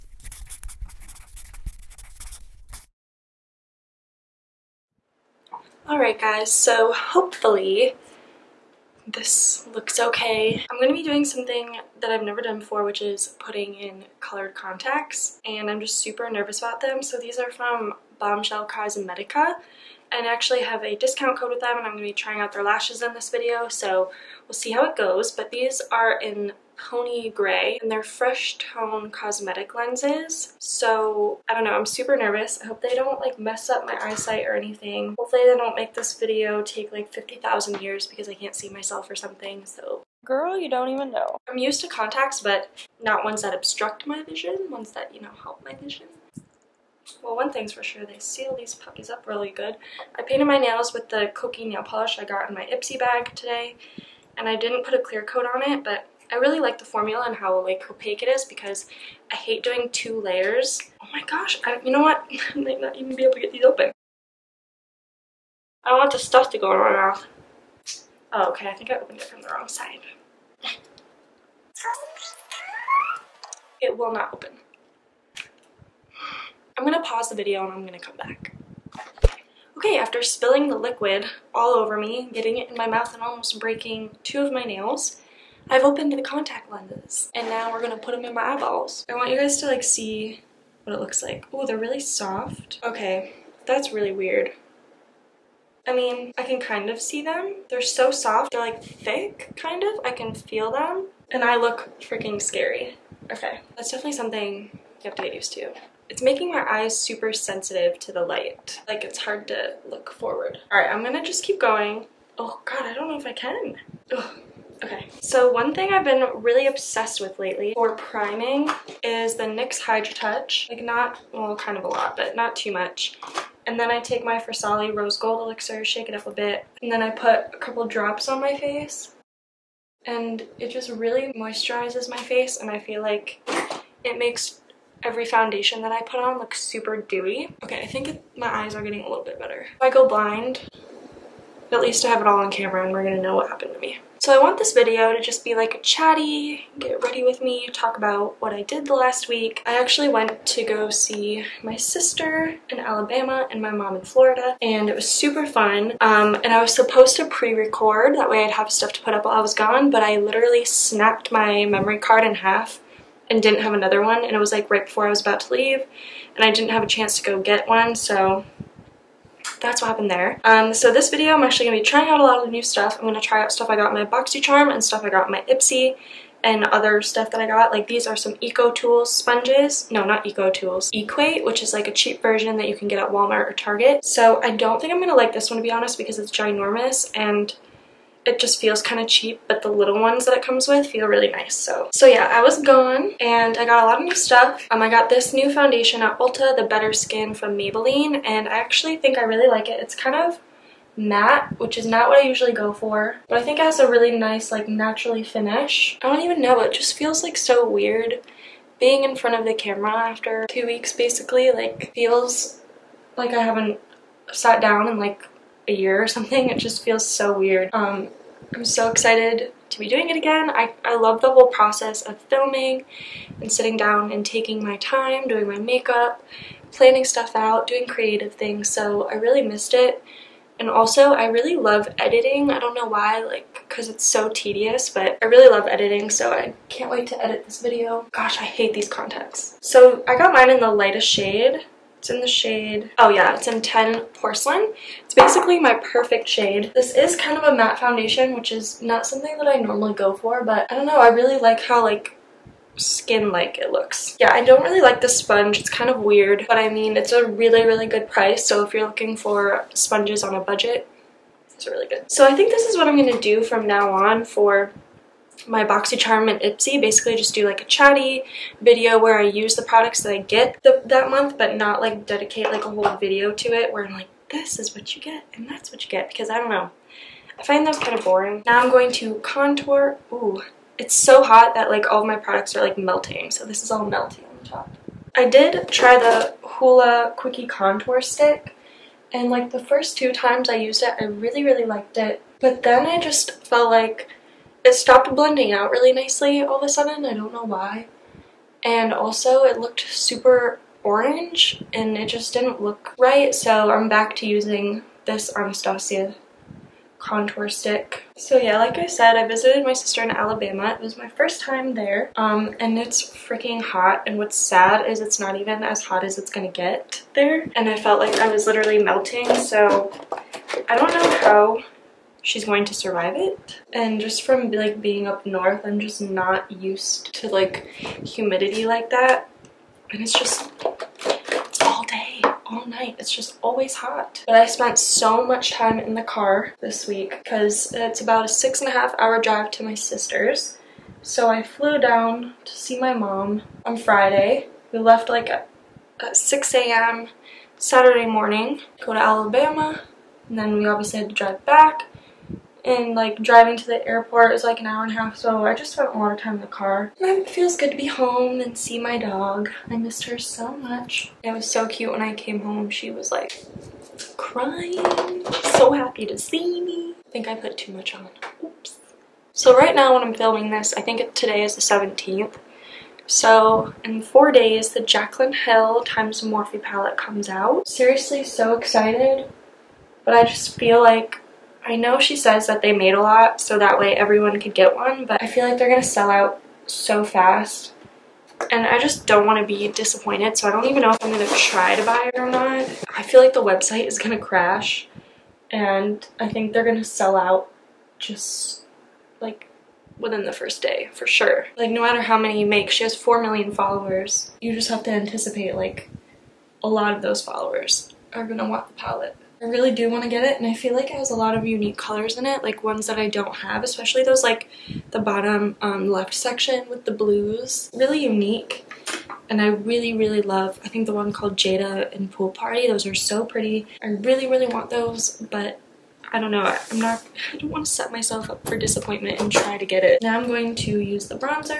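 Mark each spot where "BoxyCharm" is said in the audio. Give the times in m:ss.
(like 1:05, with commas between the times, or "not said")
2:54, 4:25.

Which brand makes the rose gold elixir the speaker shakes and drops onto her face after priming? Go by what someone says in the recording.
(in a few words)
Farsali.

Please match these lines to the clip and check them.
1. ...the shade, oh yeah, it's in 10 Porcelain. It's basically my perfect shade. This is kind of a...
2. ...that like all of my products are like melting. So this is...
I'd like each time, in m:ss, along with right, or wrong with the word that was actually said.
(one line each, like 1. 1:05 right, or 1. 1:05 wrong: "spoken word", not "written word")
1. 4:02 right
2. 4:41 right.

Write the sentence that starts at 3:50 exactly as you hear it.
And also, I really love editing.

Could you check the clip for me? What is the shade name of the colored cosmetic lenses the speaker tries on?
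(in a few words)
Pony Gray.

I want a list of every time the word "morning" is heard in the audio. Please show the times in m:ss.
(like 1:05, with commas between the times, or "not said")
5:48.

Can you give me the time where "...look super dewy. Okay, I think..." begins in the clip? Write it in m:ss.
2:16.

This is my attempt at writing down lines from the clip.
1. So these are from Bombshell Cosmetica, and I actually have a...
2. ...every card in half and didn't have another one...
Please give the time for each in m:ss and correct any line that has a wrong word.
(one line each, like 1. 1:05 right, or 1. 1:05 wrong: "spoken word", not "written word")
1. 0:17 right
2. 2:41 wrong: "memory", not "every".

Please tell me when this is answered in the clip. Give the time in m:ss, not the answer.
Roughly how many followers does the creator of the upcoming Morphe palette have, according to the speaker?
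6:42.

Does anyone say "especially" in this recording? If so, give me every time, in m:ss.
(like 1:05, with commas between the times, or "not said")
6:53.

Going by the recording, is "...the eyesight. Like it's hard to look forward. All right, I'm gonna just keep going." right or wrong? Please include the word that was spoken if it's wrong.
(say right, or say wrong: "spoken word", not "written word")
wrong: "light", not "eyesight".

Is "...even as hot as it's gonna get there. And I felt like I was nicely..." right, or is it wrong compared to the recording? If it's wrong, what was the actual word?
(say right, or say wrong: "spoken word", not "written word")
wrong: "literally", not "nicely".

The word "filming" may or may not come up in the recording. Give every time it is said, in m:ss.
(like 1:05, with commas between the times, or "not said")
3:42, 6:10.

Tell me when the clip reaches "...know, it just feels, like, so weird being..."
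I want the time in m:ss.
3:26.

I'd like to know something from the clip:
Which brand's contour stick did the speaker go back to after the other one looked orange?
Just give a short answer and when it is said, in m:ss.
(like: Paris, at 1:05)
Anastasia, at 5:05.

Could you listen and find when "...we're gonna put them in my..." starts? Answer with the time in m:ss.
1:27.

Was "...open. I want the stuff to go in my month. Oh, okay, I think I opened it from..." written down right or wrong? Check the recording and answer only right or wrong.
wrong.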